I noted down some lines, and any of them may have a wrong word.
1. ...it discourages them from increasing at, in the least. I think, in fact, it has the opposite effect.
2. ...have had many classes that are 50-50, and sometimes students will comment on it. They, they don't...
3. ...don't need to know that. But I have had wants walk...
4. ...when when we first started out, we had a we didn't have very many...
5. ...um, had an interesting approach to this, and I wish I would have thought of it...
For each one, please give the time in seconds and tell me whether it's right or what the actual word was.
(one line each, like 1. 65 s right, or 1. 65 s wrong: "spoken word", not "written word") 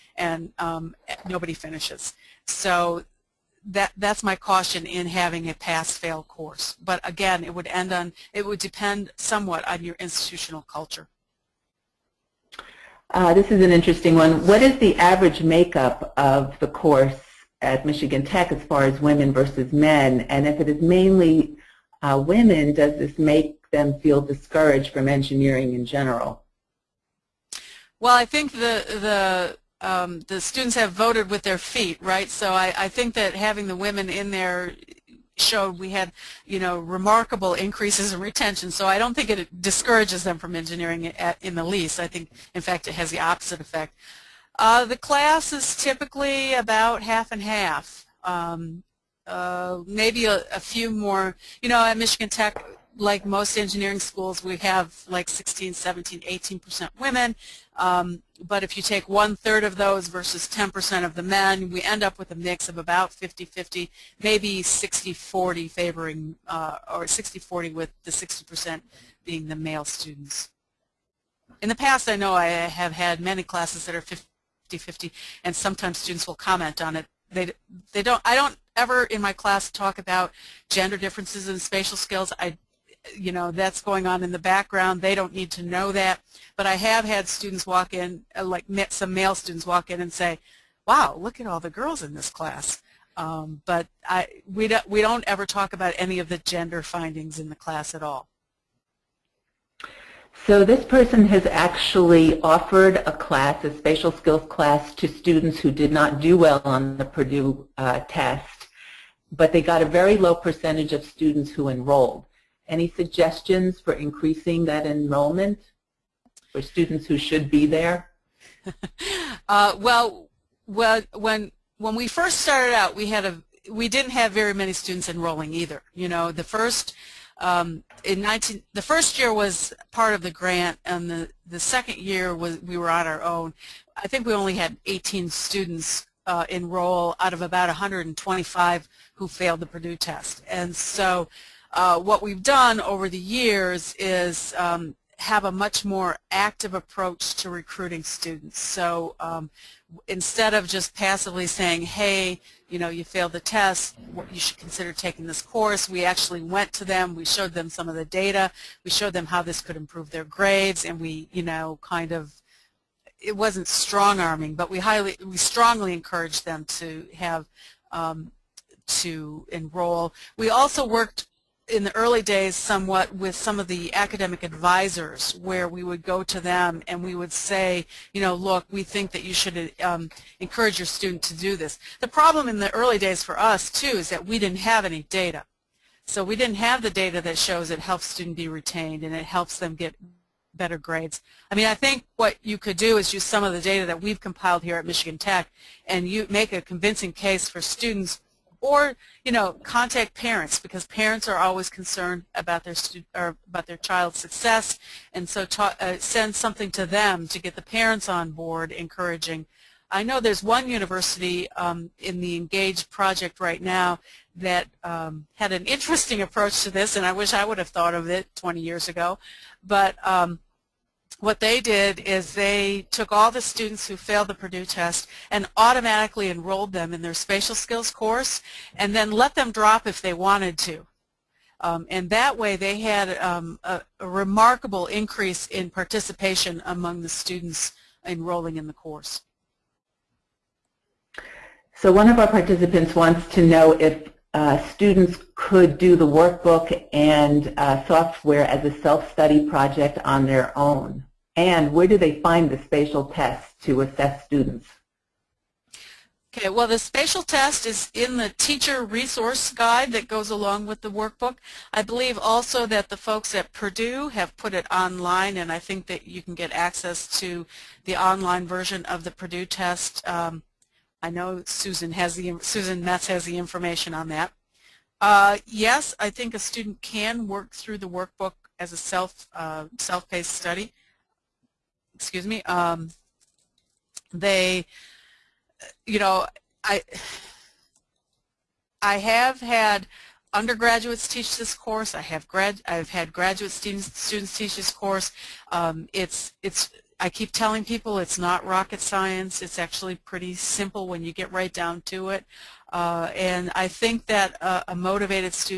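1. 39 s wrong: "engineering", not "increasing"
2. 72 s right
3. 85 s wrong: "students", not "wants"
4. 121 s right
5. 214 s right.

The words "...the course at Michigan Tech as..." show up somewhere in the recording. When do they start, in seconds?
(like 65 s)
16 s.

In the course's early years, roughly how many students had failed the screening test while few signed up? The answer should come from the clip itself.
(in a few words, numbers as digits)
125.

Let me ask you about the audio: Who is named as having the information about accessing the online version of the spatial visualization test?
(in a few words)
Susan Metz.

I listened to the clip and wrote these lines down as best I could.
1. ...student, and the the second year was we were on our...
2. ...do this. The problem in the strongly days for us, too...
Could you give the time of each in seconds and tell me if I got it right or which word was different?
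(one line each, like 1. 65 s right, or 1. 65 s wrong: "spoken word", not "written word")
1. 130 s wrong: "grant", not "student"
2. 181 s wrong: "early", not "strongly".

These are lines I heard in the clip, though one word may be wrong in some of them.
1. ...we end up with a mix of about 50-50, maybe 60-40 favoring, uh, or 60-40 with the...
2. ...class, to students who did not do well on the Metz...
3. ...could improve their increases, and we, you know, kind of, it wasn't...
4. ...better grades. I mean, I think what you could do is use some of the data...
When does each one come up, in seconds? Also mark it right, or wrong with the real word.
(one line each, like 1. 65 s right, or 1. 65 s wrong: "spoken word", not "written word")
1. 61 s right
2. 104 s wrong: "Purdue", not "Metz"
3. 159 s wrong: "grades", not "increases"
4. 190 s right.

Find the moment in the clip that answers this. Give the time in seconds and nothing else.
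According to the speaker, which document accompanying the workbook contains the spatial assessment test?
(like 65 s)
258 s.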